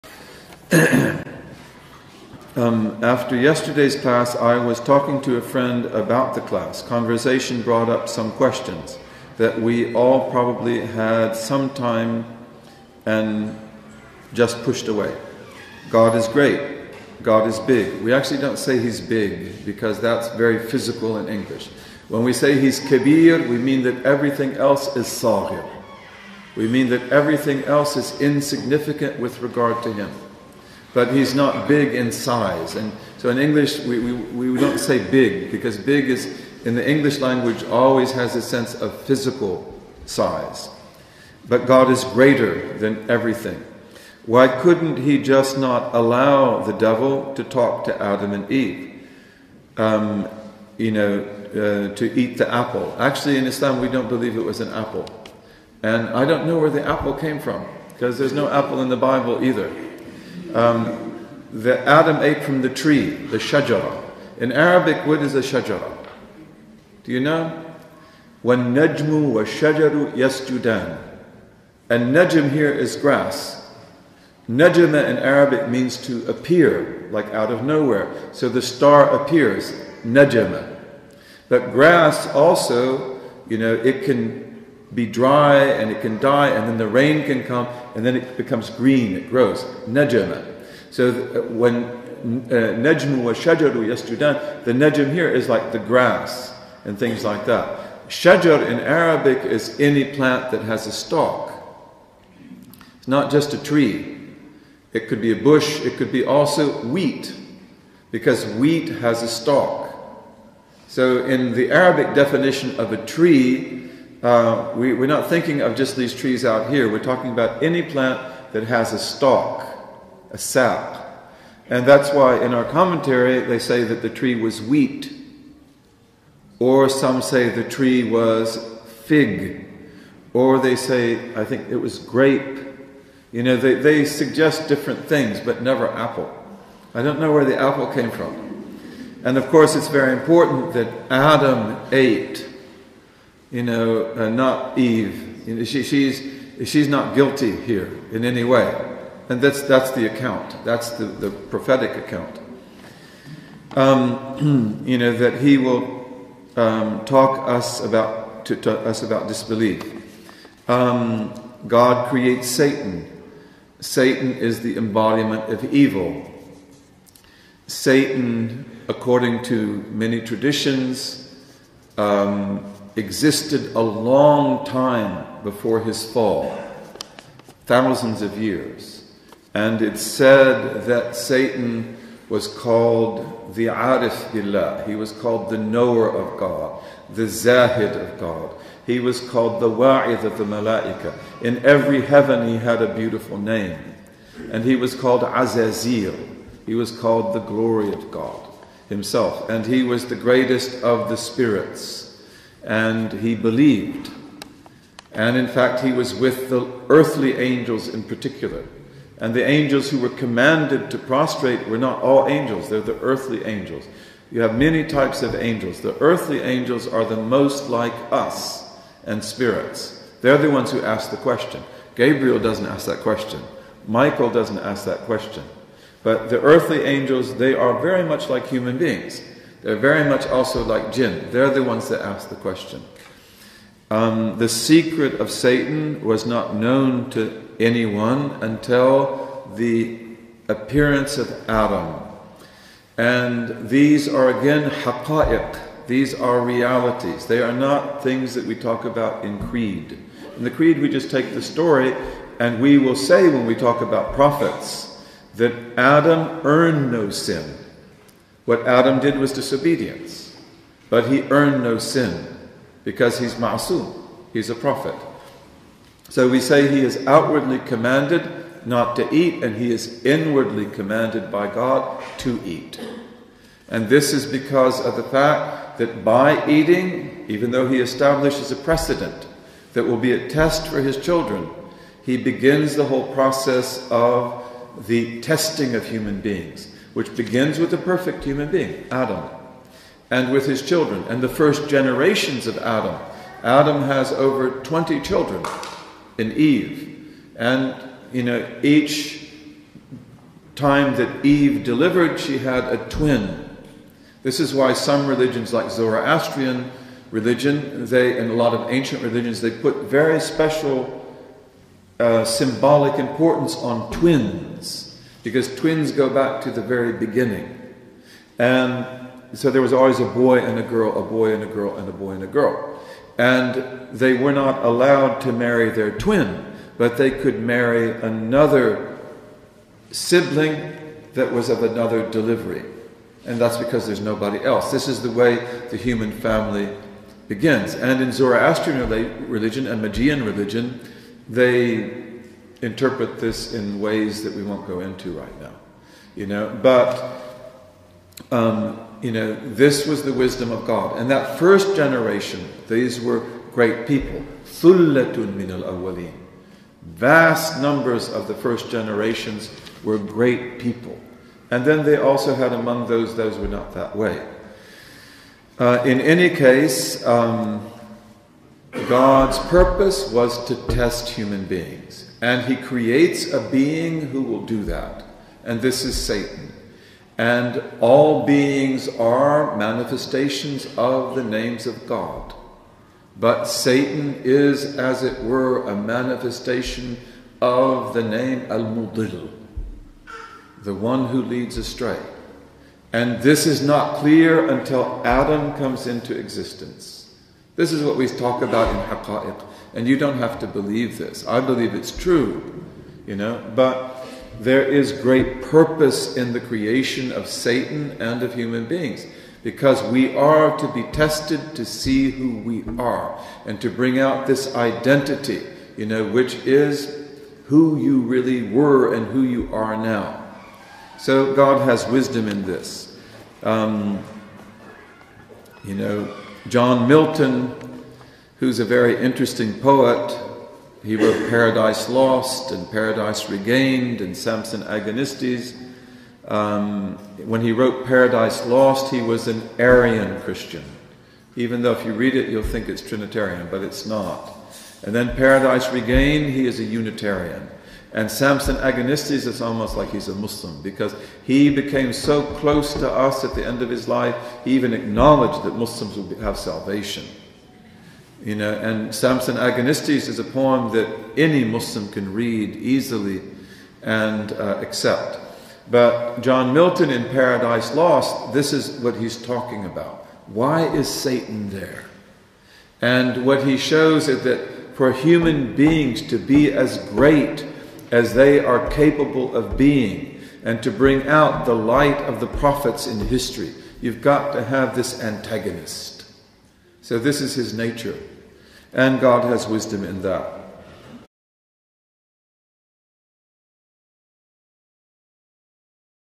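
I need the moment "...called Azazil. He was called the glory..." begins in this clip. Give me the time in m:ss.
3:14.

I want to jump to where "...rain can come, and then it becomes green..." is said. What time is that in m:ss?
1:26.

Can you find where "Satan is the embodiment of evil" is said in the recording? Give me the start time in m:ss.
2:43.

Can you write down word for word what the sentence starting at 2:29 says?
And that's, that's the account, that's the, the prophetic account.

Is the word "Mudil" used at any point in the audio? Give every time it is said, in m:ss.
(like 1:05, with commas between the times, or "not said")
6:28.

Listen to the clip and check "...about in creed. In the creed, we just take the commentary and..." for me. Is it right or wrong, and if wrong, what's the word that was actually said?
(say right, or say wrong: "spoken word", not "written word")
wrong: "story", not "commentary".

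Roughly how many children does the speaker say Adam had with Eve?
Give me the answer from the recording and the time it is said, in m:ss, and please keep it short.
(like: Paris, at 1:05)
Over 20, at 4:54.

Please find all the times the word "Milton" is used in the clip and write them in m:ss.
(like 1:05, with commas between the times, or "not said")
7:06, 7:46.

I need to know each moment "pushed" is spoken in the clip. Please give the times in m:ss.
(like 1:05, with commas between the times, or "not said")
0:14.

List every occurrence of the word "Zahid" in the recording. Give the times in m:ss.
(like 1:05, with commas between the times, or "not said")
3:07.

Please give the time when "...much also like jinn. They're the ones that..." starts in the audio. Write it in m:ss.
3:50.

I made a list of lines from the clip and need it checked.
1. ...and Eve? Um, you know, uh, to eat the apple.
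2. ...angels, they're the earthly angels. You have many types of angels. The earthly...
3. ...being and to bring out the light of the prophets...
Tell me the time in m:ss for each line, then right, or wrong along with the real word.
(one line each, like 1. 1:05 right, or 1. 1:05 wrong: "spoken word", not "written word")
1. 0:48 right
2. 3:32 right
3. 7:59 right.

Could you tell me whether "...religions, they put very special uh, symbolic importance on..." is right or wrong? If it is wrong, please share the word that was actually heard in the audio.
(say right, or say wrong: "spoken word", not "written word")
right.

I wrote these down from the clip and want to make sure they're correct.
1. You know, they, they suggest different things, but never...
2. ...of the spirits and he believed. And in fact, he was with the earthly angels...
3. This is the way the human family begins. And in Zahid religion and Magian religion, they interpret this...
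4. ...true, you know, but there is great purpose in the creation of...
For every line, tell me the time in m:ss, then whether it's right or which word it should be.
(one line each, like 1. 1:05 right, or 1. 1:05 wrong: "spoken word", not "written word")
1. 2:13 right
2. 3:20 right
3. 5:34 wrong: "Zoroastrian", not "Zahid"
4. 6:41 right.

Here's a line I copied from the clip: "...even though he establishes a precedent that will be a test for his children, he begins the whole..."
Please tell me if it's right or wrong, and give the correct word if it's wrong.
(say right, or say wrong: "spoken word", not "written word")
right.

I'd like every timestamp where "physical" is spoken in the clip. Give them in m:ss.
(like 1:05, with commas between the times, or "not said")
0:20, 0:39.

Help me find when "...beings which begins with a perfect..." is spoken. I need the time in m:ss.
4:46.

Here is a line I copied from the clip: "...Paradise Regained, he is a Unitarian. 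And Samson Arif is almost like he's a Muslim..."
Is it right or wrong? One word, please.
wrong.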